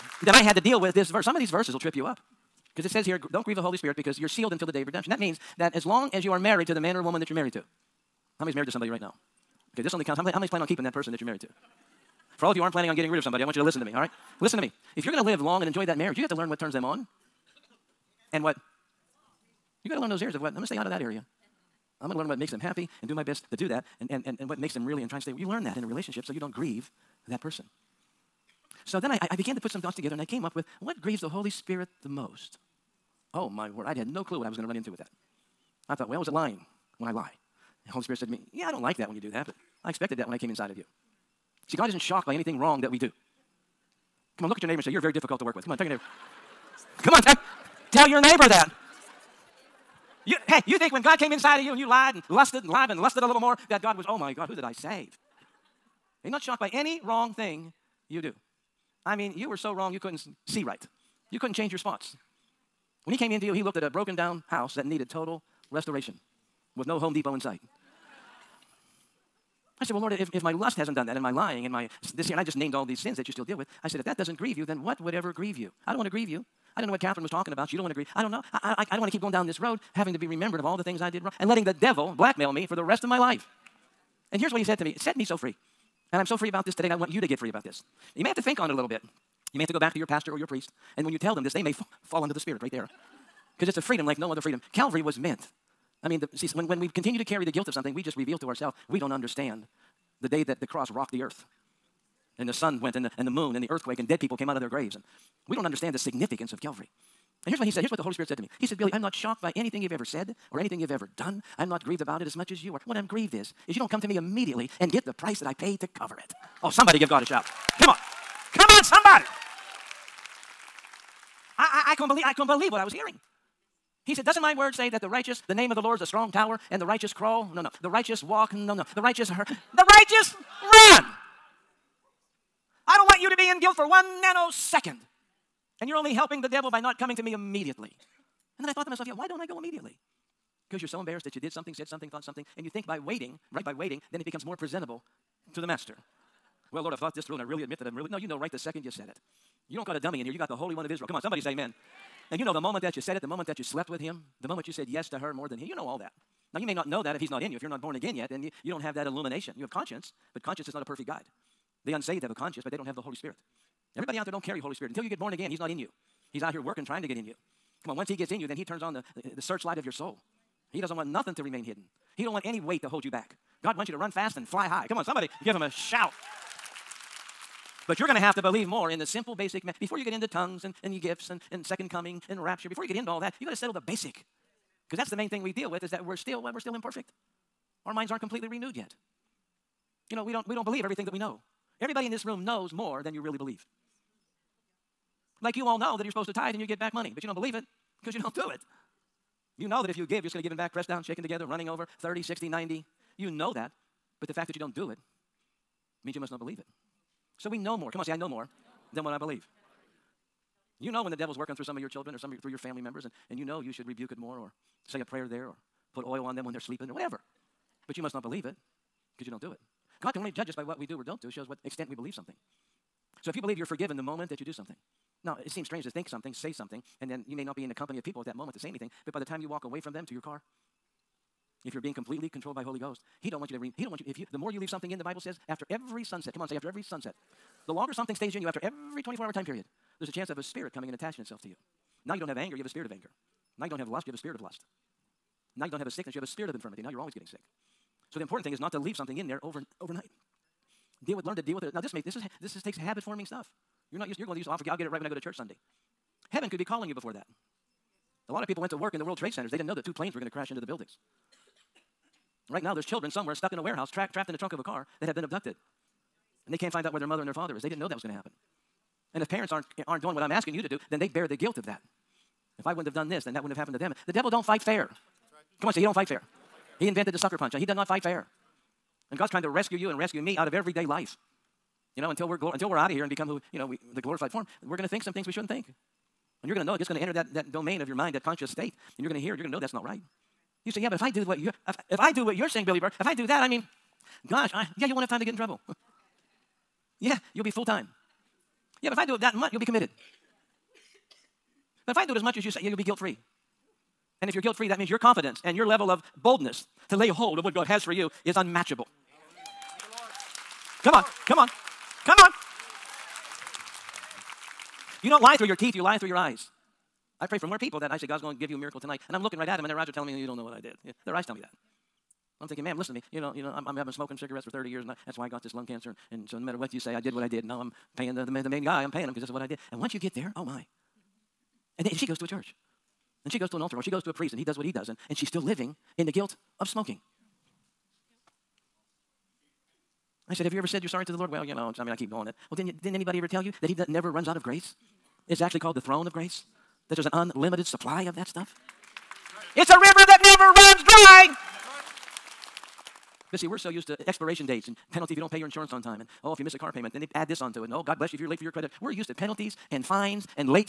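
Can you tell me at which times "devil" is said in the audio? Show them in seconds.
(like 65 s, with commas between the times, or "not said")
81 s, 136 s, 211 s, 274 s.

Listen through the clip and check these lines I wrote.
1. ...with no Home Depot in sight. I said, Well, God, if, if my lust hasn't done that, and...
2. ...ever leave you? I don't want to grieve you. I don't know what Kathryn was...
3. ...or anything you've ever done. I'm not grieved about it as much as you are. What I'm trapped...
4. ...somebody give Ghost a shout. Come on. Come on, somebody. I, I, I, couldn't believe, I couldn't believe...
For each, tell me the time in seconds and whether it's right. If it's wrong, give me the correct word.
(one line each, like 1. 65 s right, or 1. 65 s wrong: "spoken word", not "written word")
1. 66 s wrong: "Lord", not "God"
2. 75 s wrong: "grieve", not "leave"
3. 110 s wrong: "grieved", not "trapped"
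4. 116 s wrong: "God", not "Ghost".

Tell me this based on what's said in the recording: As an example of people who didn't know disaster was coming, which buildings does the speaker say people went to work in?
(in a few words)
World Trade Centers.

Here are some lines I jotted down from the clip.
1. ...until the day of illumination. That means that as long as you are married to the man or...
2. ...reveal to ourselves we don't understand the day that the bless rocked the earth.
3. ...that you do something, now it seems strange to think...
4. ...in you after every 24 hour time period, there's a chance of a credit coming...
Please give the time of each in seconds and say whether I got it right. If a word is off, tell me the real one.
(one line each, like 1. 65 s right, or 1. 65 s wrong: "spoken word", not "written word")
1. 4 s wrong: "redemption", not "illumination"
2. 98 s wrong: "cross", not "bless"
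3. 224 s right
4. 238 s wrong: "spirit", not "credit".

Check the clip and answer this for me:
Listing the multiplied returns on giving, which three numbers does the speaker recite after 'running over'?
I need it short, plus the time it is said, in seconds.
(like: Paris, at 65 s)
30, 60, 90, at 201 s.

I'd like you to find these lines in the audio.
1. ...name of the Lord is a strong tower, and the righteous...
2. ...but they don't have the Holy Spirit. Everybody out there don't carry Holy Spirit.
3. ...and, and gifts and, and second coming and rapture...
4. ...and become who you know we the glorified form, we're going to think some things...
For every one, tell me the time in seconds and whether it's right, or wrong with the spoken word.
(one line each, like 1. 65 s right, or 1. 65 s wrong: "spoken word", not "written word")
1. 125 s right
2. 162 s right
3. 180 s right
4. 283 s right.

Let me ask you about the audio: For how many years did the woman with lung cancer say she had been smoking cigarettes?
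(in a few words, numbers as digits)
30.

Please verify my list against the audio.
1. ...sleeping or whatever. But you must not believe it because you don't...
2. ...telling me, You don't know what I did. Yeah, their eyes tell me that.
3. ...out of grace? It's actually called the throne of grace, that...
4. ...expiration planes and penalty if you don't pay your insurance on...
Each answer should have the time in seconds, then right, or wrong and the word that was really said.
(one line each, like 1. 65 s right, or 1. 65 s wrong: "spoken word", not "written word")
1. 216 s right
2. 319 s right
3. 344 s right
4. 354 s wrong: "dates", not "planes".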